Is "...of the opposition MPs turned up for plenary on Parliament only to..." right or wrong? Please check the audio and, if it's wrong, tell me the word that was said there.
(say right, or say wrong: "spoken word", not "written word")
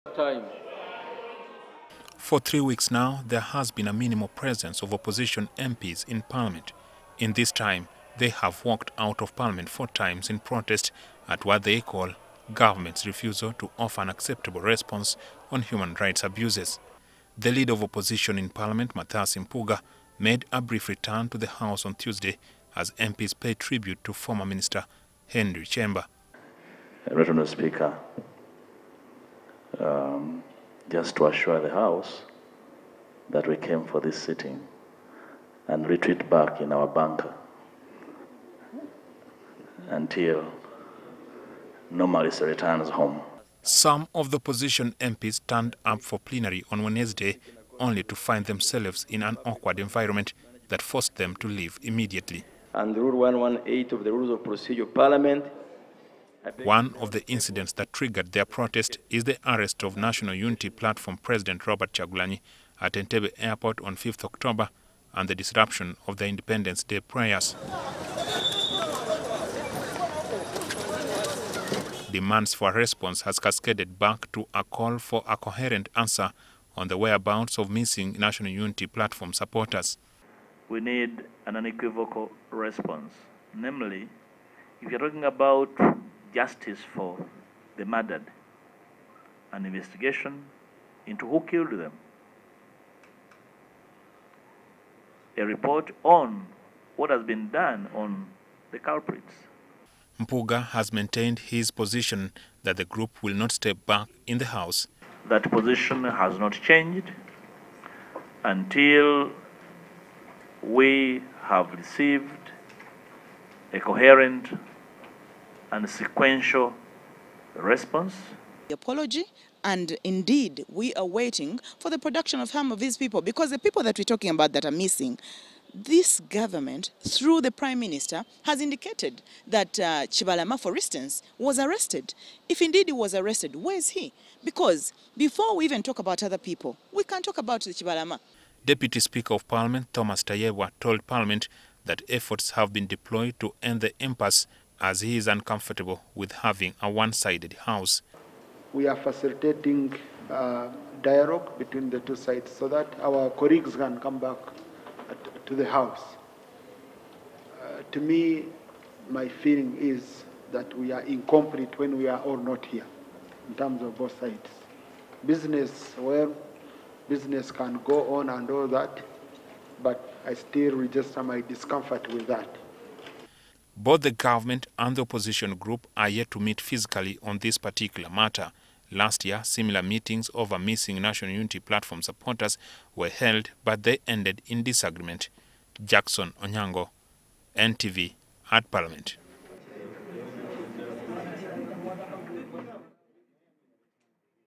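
wrong: "Wednesday", not "Parliament".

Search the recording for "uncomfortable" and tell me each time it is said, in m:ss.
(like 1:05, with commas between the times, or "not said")
2:25.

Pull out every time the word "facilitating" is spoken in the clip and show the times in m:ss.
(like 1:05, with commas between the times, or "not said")
2:28.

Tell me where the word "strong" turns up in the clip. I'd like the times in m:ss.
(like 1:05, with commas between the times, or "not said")
not said.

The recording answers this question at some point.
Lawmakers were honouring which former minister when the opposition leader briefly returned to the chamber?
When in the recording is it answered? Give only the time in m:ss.
0:25.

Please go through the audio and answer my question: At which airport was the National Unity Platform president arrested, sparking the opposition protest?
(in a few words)
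Entebbe Airport.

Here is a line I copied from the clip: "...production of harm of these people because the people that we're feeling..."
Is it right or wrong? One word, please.
wrong.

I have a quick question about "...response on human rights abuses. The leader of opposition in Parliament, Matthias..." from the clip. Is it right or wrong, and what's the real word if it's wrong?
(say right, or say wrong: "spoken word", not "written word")
right.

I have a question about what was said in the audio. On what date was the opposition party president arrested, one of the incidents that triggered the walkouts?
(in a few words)
5th October.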